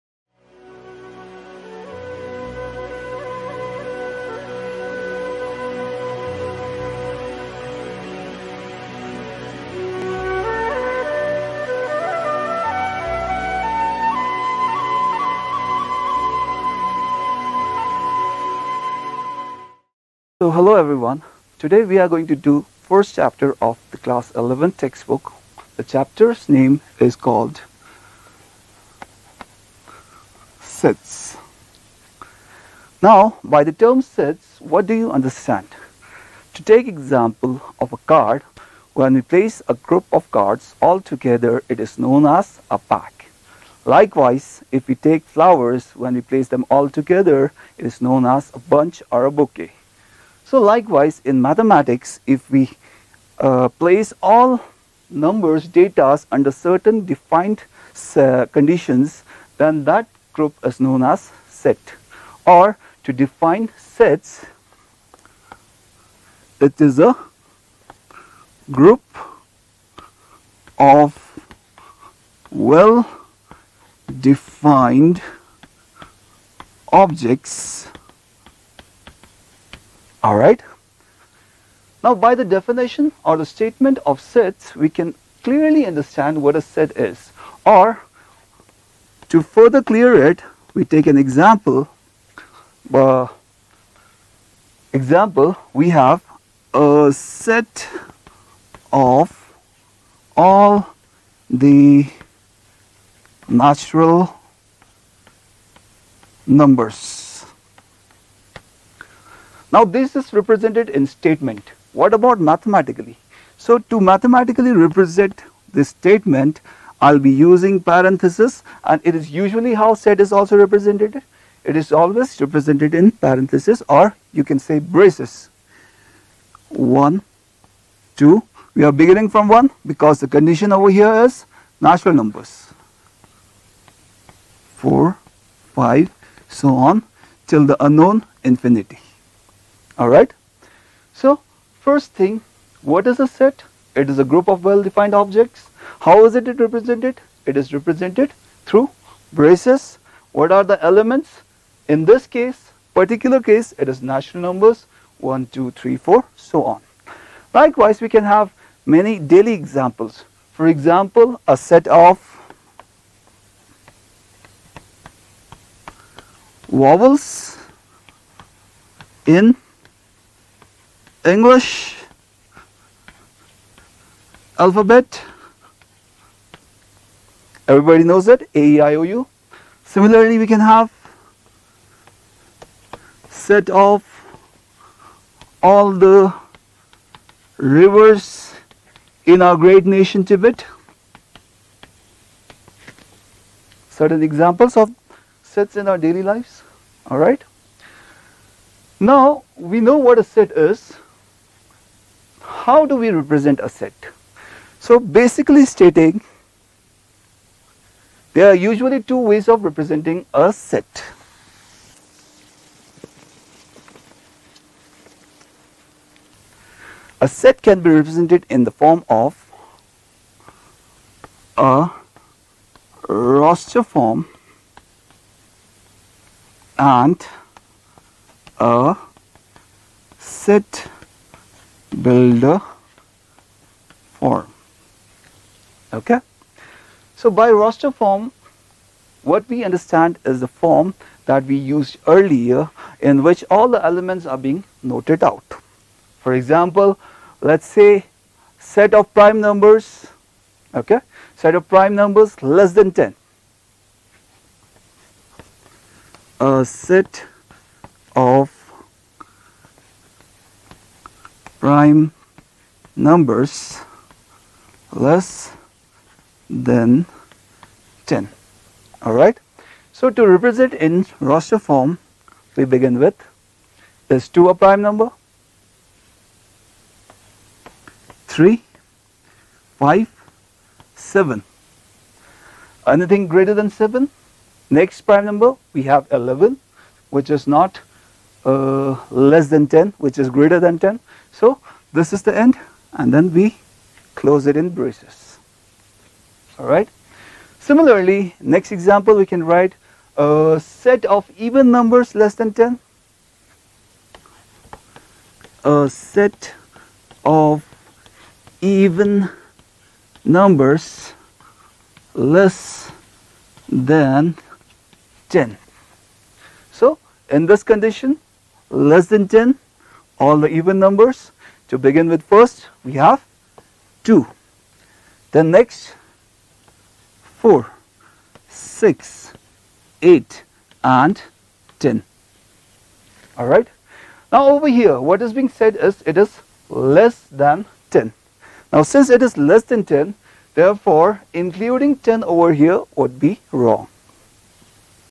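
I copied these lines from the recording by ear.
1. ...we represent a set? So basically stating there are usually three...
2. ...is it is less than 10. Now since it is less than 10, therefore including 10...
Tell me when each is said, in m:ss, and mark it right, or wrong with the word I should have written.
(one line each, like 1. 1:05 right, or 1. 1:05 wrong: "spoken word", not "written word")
1. 3:22 wrong: "two", not "three"
2. 5:35 right.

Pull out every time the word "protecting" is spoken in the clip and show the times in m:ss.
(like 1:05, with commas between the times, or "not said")
not said.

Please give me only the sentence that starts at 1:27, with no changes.
Or to further clear it, we take an example.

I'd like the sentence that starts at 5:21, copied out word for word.
To begin with first, we have 2.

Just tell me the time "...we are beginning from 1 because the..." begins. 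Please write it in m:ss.
2:08.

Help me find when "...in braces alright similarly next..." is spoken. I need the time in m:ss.
4:54.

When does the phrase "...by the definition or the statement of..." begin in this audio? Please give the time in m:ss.
1:22.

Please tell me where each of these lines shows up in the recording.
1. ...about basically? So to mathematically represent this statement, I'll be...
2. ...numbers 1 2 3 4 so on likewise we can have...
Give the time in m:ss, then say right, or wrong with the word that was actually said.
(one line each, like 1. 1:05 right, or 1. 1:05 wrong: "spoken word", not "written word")
1. 1:52 wrong: "mathematically", not "basically"
2. 2:34 right.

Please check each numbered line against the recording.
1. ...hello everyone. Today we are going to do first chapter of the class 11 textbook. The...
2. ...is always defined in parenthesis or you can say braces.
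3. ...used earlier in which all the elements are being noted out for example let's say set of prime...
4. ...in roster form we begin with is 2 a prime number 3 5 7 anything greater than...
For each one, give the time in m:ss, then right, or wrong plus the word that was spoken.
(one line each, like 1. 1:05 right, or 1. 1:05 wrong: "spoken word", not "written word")
1. 0:20 right
2. 2:01 wrong: "represented", not "defined"
3. 4:01 right
4. 4:30 right.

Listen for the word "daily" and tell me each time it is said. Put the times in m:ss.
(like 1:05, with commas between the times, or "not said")
2:39, 3:15.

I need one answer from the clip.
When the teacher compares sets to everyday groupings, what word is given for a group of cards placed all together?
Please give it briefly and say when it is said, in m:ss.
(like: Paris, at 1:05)
pack, at 0:42.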